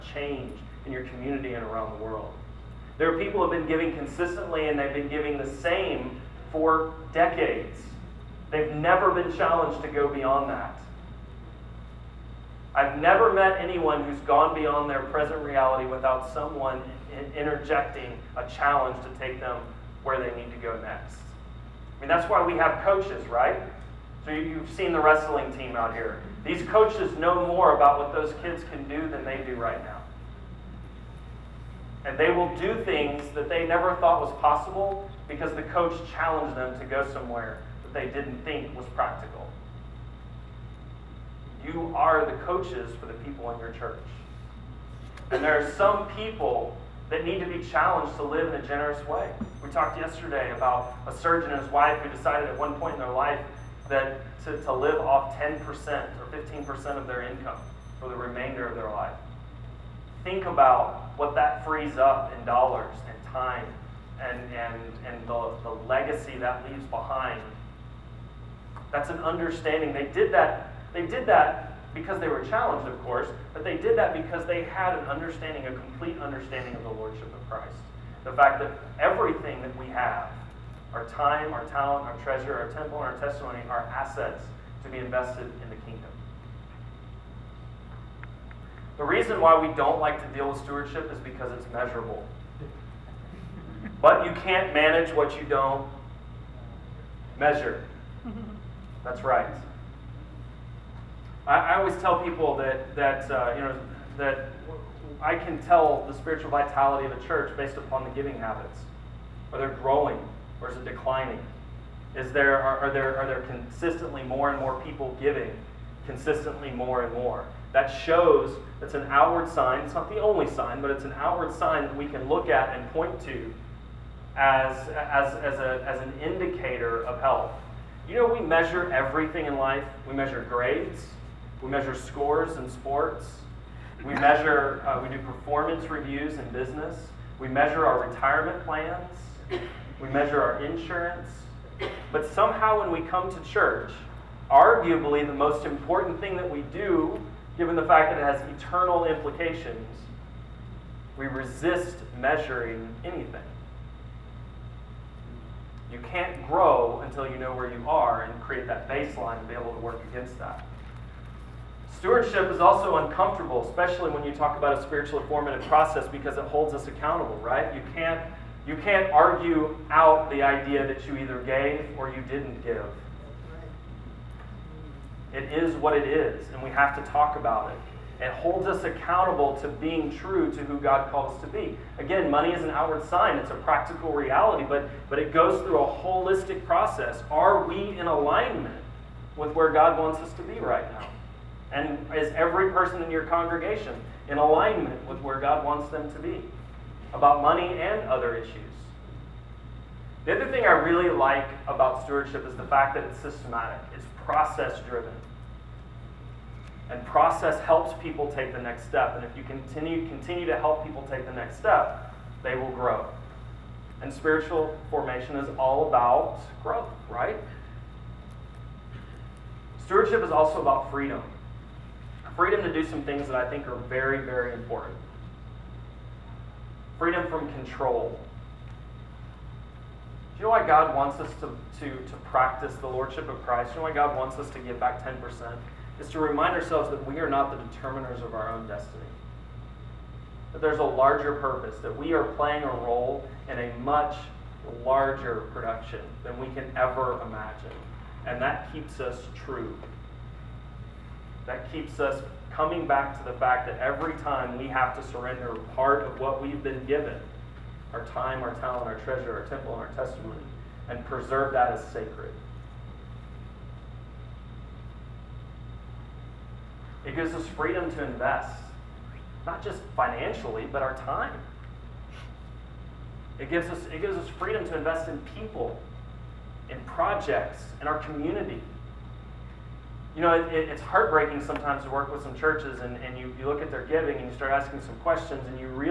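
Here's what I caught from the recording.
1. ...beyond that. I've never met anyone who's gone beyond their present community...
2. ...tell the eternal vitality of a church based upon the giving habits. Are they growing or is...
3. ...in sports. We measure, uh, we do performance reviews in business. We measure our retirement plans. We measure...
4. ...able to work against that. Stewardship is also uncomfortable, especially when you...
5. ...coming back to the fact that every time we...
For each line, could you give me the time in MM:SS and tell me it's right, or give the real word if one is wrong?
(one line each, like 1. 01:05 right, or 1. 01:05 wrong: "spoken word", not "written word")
1. 00:10 wrong: "reality", not "community"
2. 01:45 wrong: "spiritual", not "eternal"
3. 02:12 right
4. 02:39 right
5. 04:12 right.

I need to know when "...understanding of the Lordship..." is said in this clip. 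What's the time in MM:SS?
01:16.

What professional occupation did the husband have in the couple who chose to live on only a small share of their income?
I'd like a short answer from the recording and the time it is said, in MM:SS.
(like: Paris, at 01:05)
Surgeon, at 00:51.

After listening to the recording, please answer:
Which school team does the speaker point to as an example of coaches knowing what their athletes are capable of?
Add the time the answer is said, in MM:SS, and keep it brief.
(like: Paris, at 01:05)
Wrestling team, at 00:25.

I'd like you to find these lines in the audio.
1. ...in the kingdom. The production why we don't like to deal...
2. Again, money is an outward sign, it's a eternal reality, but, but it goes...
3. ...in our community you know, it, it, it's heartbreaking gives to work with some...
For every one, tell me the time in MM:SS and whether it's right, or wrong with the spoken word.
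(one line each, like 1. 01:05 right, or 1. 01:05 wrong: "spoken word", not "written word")
1. 01:25 wrong: "reason", not "production"
2. 03:01 wrong: "practical", not "eternal"
3. 04:37 wrong: "sometimes", not "gives".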